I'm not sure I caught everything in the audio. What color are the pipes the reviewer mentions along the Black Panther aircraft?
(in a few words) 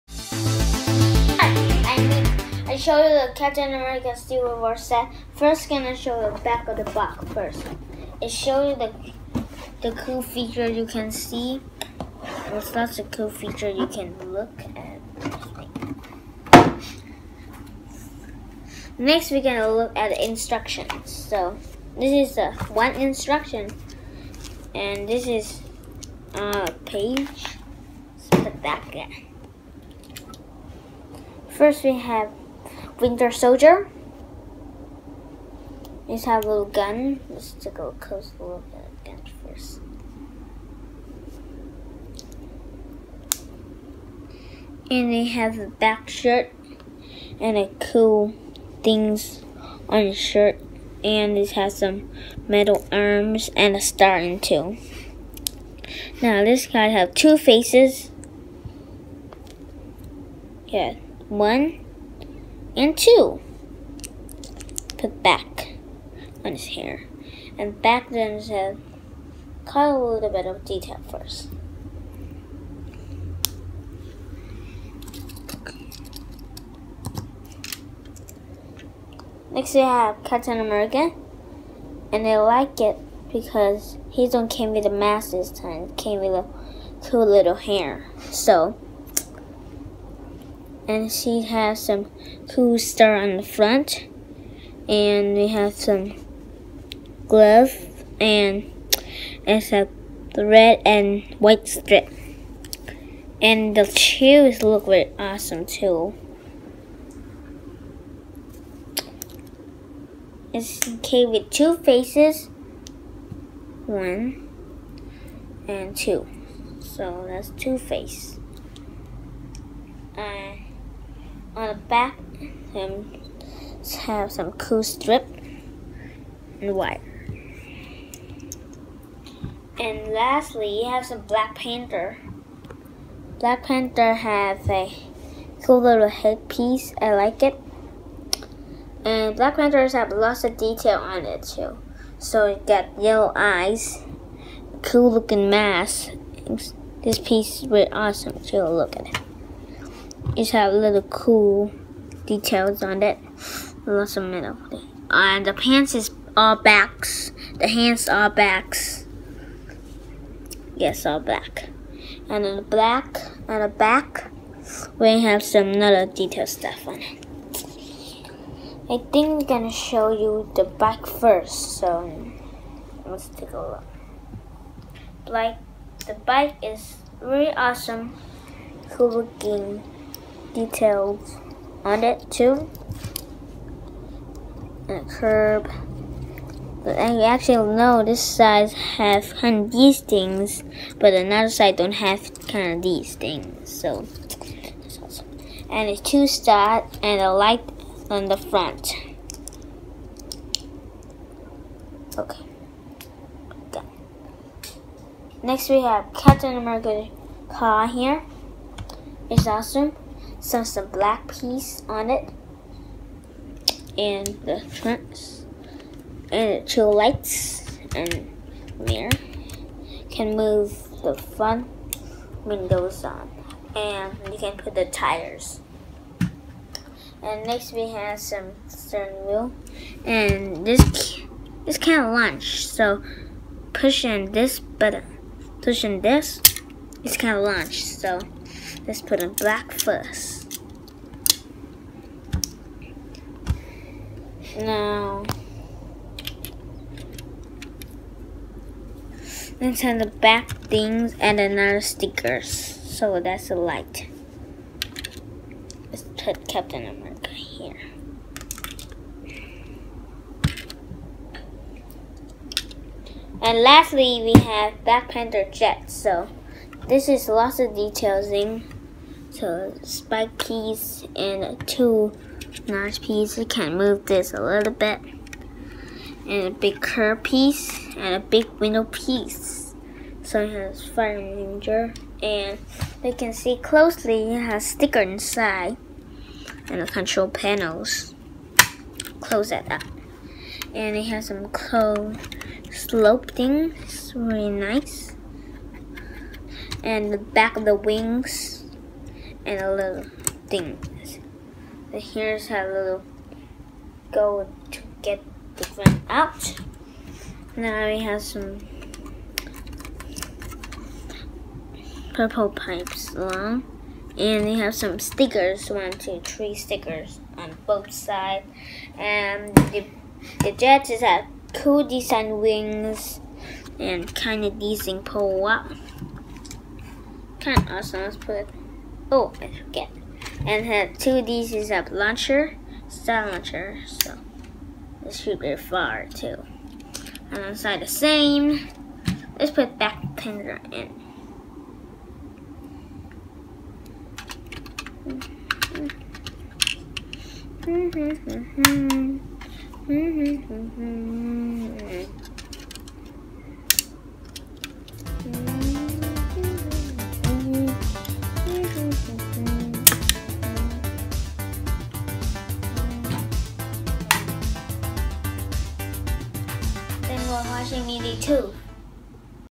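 purple.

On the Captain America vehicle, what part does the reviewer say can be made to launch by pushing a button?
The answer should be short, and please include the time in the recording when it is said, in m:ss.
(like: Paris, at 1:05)
steering wheel, at 3:48.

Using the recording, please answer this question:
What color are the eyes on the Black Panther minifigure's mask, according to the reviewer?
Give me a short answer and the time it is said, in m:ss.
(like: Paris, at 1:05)
yellow, at 2:23.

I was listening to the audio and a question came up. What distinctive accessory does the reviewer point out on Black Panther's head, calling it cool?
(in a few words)
headpiece.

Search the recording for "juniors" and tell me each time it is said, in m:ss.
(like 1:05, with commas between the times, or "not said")
not said.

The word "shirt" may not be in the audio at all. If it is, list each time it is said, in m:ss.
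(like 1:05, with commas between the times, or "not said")
0:46, 0:50.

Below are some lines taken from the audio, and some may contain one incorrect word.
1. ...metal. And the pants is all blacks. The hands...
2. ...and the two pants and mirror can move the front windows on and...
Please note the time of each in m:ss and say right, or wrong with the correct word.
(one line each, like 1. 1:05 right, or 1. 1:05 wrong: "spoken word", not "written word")
1. 2:34 right
2. 3:36 wrong: "lights", not "pants".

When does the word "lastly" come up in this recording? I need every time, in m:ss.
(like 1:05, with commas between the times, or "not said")
2:10, 4:23.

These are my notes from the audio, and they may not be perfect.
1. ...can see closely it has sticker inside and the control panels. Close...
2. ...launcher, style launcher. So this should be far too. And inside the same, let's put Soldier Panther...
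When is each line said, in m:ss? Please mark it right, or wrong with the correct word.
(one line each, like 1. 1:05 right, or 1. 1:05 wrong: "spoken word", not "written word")
1. 4:43 right
2. 5:31 wrong: "Black", not "Soldier".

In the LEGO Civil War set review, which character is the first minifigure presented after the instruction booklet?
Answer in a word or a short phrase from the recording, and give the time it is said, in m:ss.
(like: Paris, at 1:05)
Winter Soldier, at 0:33.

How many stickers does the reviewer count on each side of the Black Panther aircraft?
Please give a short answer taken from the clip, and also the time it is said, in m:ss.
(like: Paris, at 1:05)
3, at 5:16.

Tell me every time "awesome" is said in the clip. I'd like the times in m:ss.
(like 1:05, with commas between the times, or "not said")
1:45, 2:27, 2:57, 3:14, 3:29, 5:27.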